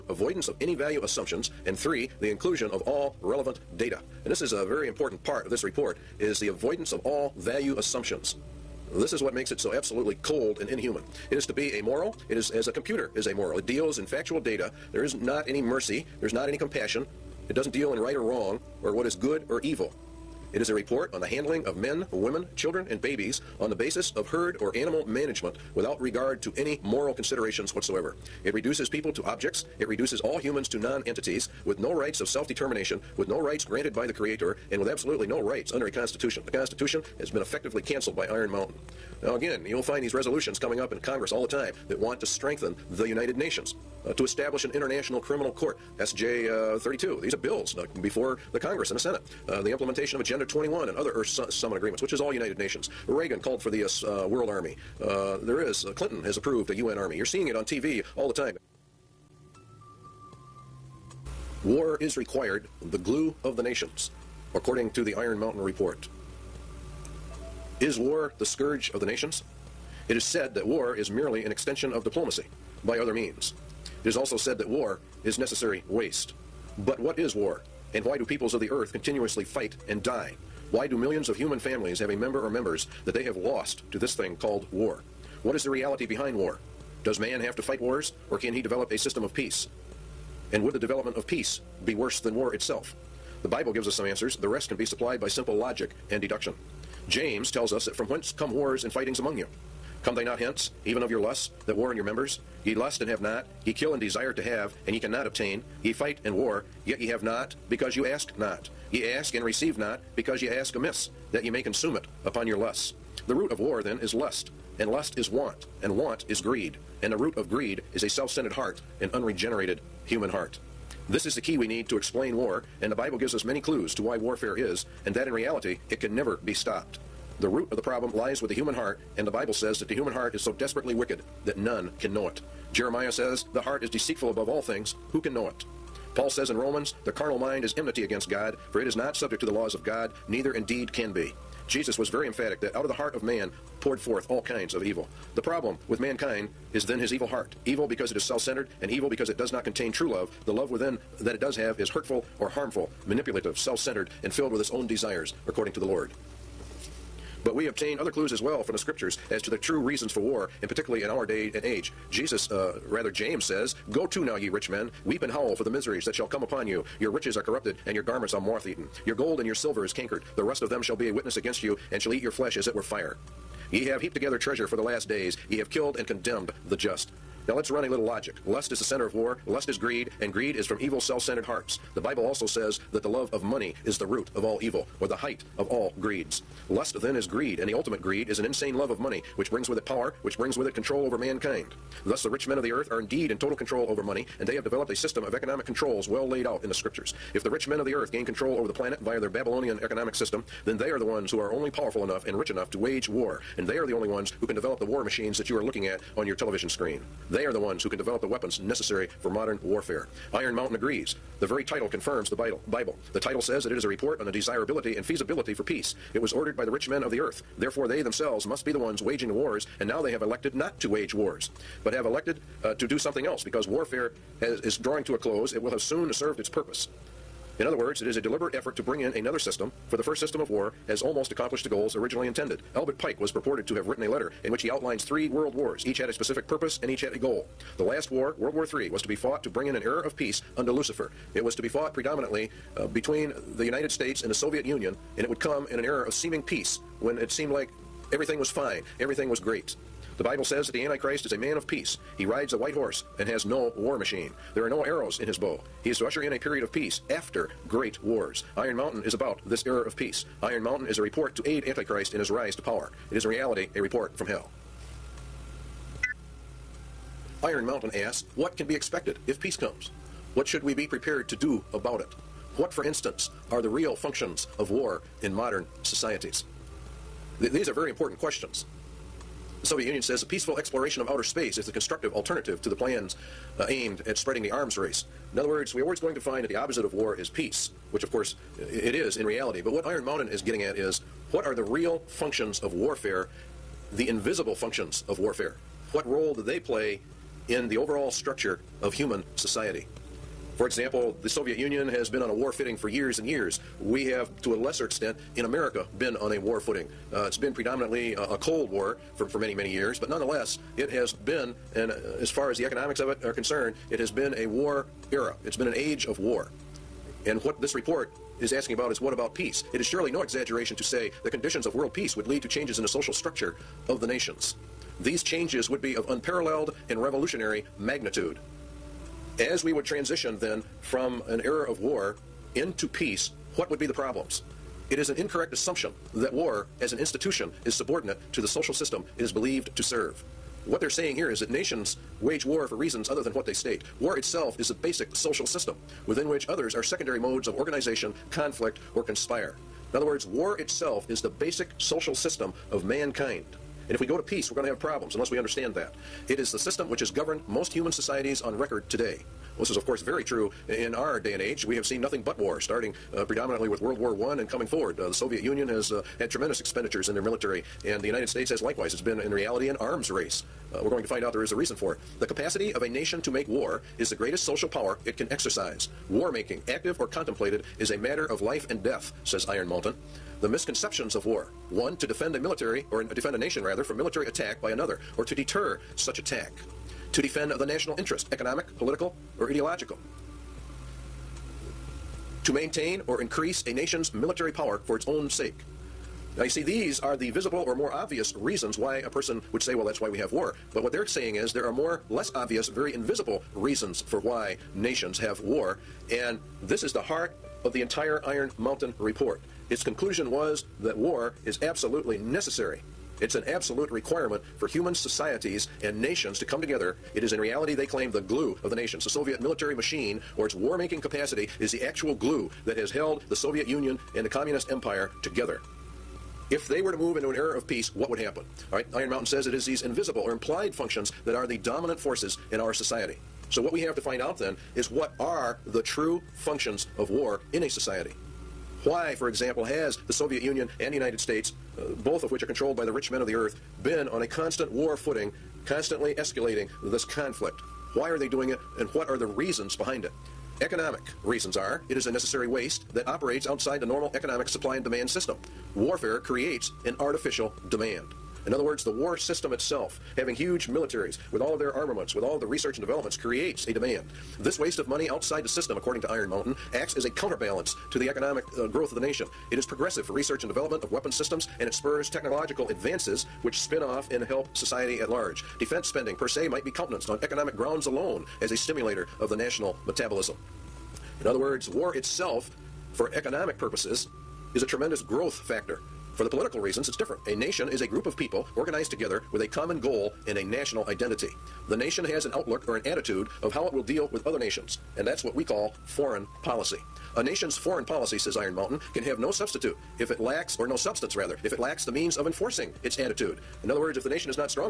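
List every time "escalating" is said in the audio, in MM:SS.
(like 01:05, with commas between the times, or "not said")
07:26.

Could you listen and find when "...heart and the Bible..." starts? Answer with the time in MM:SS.
02:08.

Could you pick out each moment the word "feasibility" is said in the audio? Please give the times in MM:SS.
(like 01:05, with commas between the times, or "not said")
03:35.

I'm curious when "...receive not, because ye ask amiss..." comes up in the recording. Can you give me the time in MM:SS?
01:49.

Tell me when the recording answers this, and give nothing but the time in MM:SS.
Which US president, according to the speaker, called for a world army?
00:53.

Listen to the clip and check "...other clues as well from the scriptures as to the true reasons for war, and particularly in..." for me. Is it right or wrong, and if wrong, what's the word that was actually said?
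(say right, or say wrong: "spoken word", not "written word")
right.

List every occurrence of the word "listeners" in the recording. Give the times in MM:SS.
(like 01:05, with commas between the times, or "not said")
not said.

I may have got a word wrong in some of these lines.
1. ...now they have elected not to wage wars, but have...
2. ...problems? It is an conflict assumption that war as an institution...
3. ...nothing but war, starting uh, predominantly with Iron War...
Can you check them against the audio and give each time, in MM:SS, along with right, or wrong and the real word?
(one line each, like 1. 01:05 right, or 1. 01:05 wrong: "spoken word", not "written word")
1. 03:39 right
2. 05:33 wrong: "incorrect", not "conflict"
3. 06:02 wrong: "World", not "Iron".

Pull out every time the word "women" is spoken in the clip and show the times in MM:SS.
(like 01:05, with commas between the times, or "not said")
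00:22.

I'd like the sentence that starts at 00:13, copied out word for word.
It deals in factual data there is not any mercy.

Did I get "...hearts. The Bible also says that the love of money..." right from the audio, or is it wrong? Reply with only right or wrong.
right.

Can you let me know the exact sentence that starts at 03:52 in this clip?
Albert Pike was purported to have written a letter in which he outlines three world wars.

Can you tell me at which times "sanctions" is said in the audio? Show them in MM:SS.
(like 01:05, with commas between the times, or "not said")
not said.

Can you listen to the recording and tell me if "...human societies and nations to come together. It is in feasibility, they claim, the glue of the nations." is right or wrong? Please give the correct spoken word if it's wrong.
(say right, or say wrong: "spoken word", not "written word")
wrong: "reality", not "feasibility".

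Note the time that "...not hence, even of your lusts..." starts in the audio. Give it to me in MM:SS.
01:40.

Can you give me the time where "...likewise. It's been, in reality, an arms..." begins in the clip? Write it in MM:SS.
06:08.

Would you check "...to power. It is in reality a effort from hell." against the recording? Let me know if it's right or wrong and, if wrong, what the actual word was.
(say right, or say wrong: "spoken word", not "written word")
wrong: "report", not "effort".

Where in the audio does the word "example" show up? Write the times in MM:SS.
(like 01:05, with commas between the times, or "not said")
05:00, 07:19.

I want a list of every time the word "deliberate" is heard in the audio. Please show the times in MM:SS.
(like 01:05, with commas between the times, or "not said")
03:48.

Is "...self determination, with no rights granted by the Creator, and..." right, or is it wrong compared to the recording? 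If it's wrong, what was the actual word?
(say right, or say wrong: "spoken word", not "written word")
right.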